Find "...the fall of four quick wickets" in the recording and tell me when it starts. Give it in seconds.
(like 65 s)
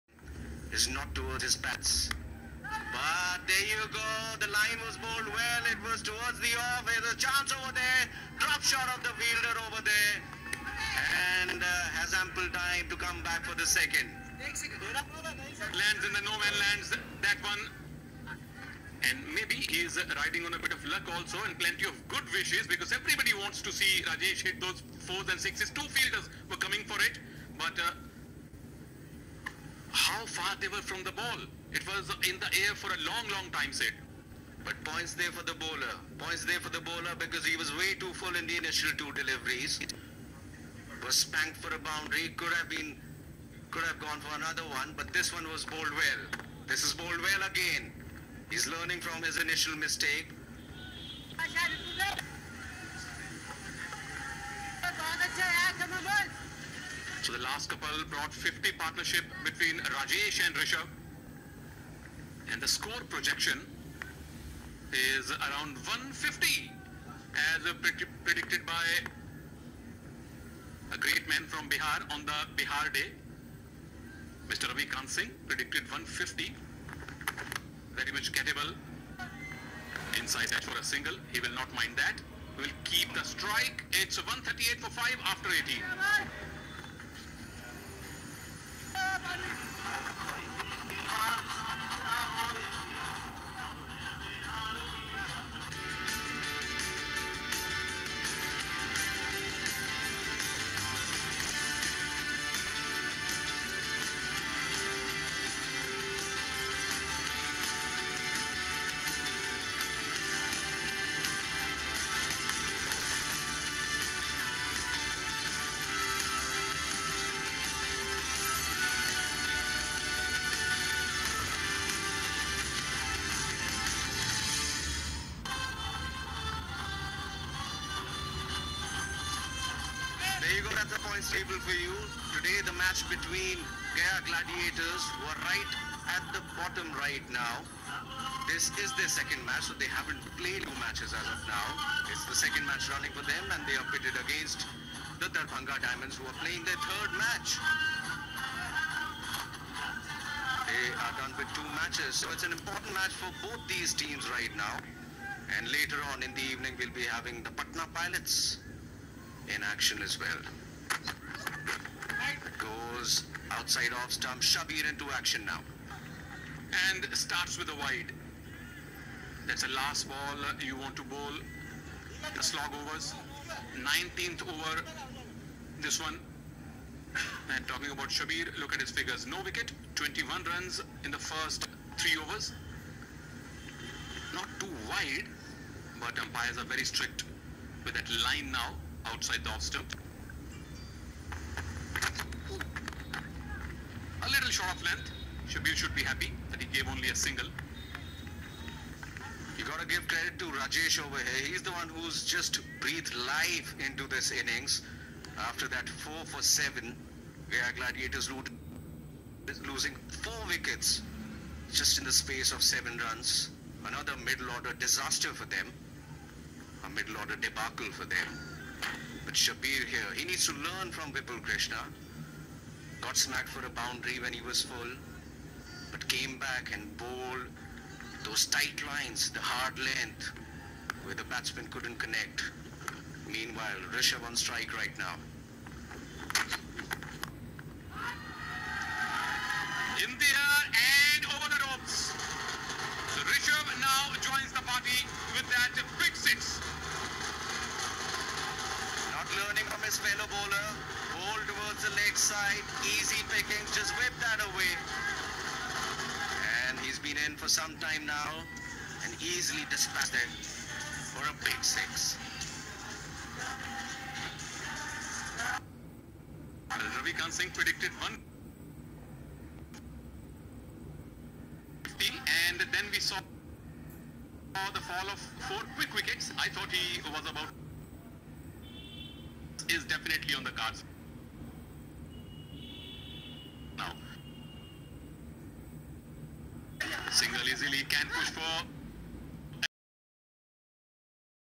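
274 s.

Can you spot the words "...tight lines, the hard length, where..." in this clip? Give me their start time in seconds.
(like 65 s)
228 s.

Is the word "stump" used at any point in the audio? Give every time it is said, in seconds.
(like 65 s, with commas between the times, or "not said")
164 s, 189 s.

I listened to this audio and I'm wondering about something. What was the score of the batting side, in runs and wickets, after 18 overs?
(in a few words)
138 for 5.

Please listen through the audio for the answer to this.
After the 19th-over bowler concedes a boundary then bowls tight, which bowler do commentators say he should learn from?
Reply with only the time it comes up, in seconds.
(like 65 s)
221 s.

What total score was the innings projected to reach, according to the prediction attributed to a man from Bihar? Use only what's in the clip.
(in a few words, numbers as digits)
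150.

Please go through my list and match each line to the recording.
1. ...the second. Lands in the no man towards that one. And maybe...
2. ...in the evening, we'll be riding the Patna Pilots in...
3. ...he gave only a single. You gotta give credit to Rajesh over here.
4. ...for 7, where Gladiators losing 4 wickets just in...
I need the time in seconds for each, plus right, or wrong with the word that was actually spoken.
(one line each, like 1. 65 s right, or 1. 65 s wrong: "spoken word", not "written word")
1. 13 s wrong: "lands", not "towards"
2. 156 s wrong: "having", not "riding"
3. 196 s right
4. 206 s right.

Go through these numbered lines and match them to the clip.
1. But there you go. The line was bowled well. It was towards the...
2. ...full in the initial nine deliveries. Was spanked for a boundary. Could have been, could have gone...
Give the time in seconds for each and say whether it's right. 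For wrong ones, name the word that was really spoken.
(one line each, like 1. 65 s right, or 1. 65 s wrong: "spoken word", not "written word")
1. 2 s right
2. 38 s wrong: "two", not "nine".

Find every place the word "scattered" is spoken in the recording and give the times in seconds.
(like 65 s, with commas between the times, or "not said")
not said.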